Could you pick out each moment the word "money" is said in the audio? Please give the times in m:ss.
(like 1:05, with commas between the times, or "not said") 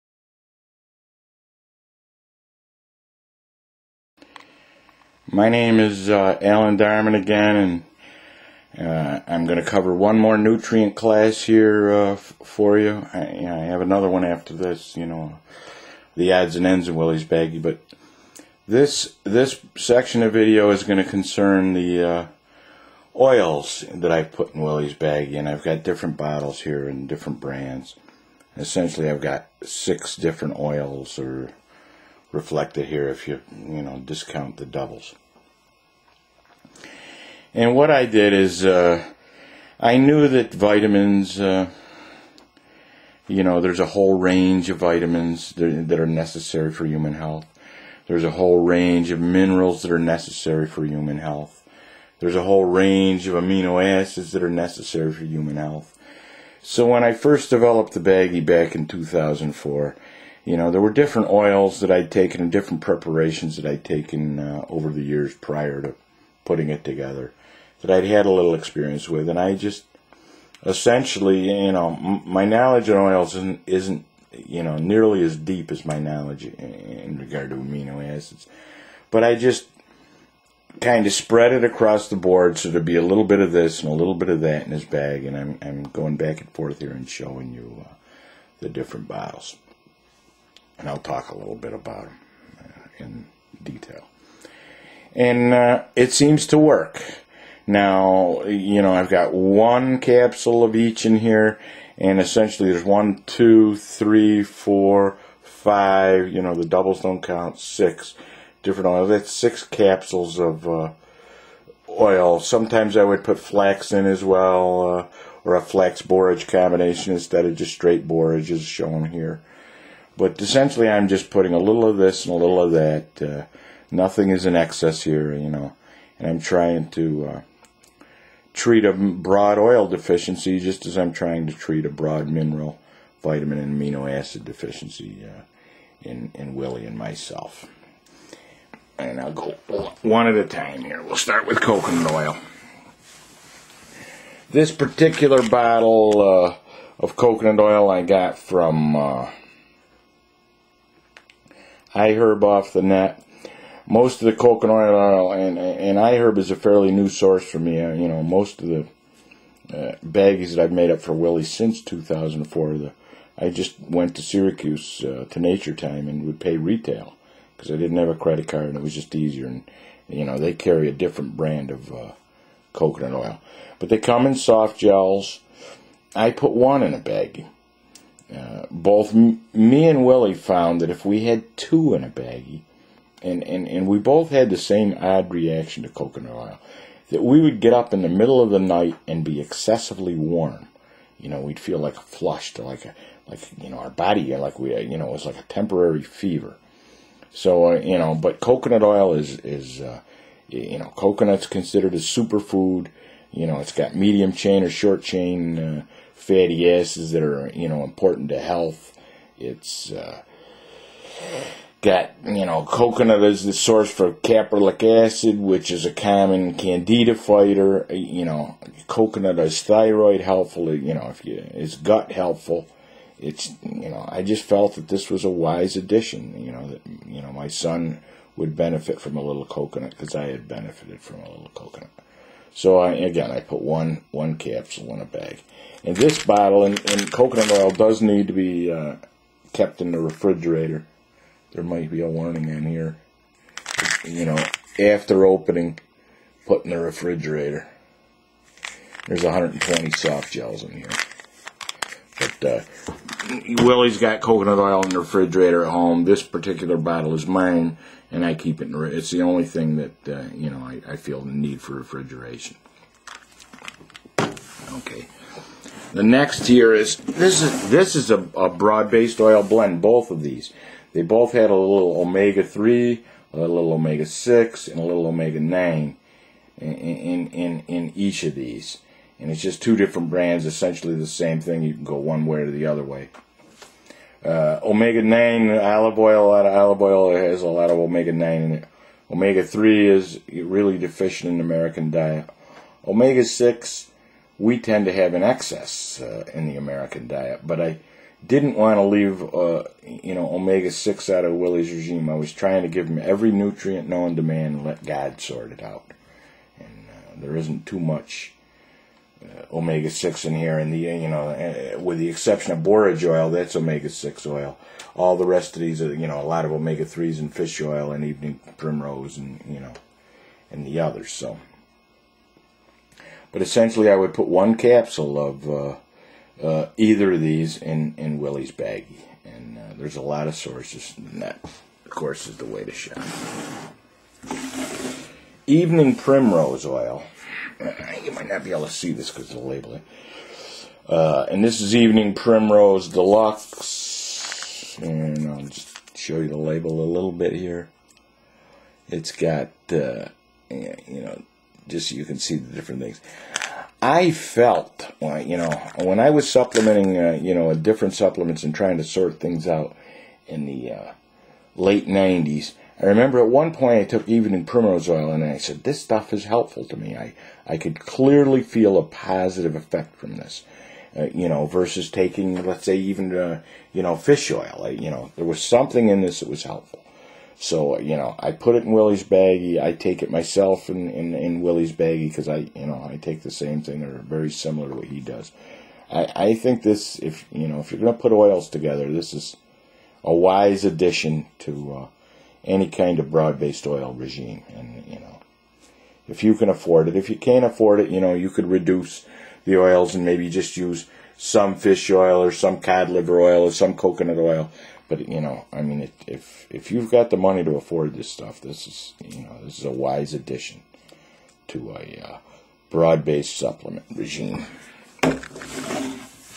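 6:47.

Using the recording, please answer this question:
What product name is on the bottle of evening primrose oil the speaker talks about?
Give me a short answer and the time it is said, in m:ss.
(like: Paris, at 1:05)
Evening Primrose Deluxe, at 5:41.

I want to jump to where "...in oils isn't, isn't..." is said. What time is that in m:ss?
1:12.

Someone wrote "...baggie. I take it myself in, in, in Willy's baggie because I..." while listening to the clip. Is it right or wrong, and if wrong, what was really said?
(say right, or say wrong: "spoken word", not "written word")
right.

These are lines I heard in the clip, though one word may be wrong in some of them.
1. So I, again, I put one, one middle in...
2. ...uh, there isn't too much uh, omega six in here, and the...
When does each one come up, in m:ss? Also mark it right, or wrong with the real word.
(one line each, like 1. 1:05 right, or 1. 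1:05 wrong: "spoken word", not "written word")
1. 3:52 wrong: "capsule", not "middle"
2. 5:06 right.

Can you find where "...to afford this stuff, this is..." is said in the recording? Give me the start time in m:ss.
6:47.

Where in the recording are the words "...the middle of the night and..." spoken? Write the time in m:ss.
3:08.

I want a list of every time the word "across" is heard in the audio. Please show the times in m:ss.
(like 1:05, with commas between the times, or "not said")
1:21.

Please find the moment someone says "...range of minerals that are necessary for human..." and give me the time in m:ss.
0:48.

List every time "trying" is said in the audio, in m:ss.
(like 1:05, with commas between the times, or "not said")
2:06, 2:11, 5:02, 5:58.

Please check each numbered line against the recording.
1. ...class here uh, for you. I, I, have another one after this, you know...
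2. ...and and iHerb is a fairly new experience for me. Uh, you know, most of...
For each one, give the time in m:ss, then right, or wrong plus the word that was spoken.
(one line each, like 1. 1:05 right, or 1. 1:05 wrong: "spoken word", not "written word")
1. 0:10 right
2. 2:35 wrong: "source", not "experience".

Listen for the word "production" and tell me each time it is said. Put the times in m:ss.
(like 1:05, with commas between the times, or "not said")
not said.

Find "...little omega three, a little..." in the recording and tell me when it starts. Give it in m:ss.
4:31.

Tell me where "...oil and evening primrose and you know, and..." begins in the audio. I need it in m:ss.
5:17.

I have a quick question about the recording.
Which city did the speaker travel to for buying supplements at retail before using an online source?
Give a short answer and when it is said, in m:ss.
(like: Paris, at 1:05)
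Syracuse, at 2:44.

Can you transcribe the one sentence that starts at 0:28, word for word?
Essentially, I've got six different oils or reflected here if you, you know, discount the doubles.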